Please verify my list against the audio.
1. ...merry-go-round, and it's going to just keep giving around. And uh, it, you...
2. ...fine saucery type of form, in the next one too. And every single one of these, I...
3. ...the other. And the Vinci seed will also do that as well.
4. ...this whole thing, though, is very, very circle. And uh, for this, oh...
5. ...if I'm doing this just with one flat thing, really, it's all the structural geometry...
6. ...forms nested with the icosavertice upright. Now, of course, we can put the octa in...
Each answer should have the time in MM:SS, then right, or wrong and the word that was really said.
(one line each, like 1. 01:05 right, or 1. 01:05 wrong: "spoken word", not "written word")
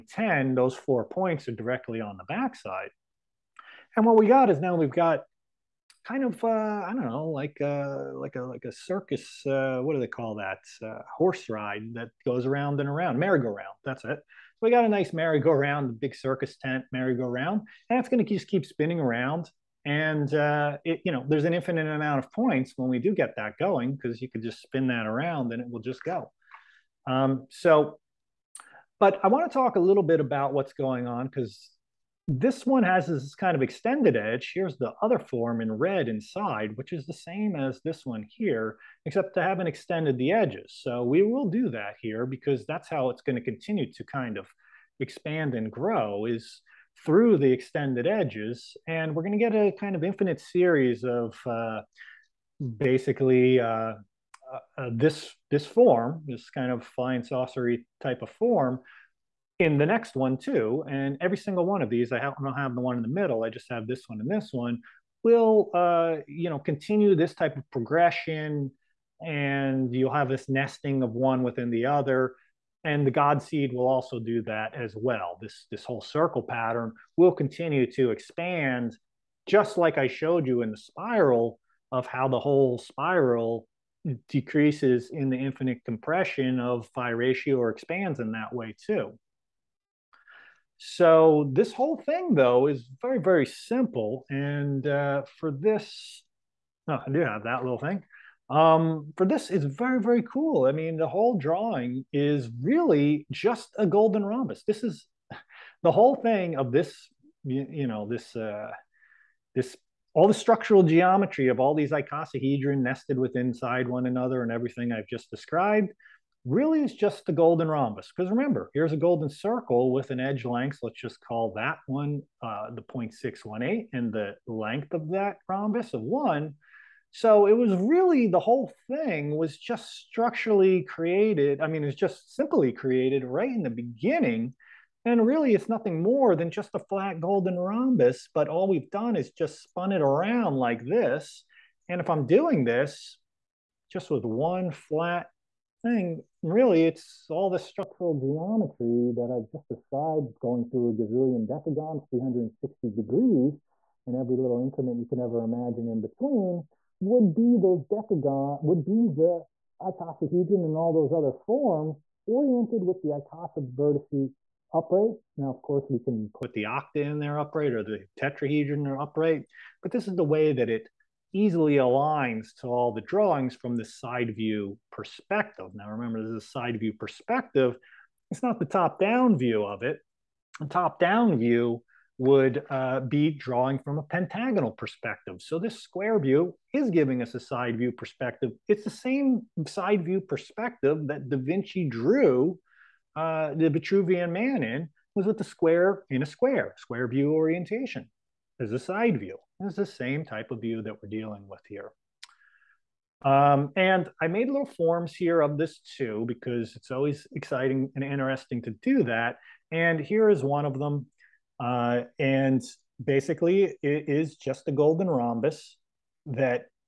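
1. 00:16 wrong: "spinning", not "giving"
2. 00:56 right
3. 01:11 wrong: "God", not "Vinci"
4. 01:31 wrong: "simple", not "circle"
5. 02:22 right
6. 02:41 wrong: "oriented", not "nested".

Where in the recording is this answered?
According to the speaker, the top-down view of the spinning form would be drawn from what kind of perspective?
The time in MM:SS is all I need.
03:04.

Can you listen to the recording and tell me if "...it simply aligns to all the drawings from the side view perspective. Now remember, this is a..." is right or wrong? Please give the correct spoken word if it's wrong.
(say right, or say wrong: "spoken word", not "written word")
wrong: "easily", not "simply".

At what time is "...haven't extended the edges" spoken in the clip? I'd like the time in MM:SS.
00:39.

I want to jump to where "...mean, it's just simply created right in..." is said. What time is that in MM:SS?
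02:11.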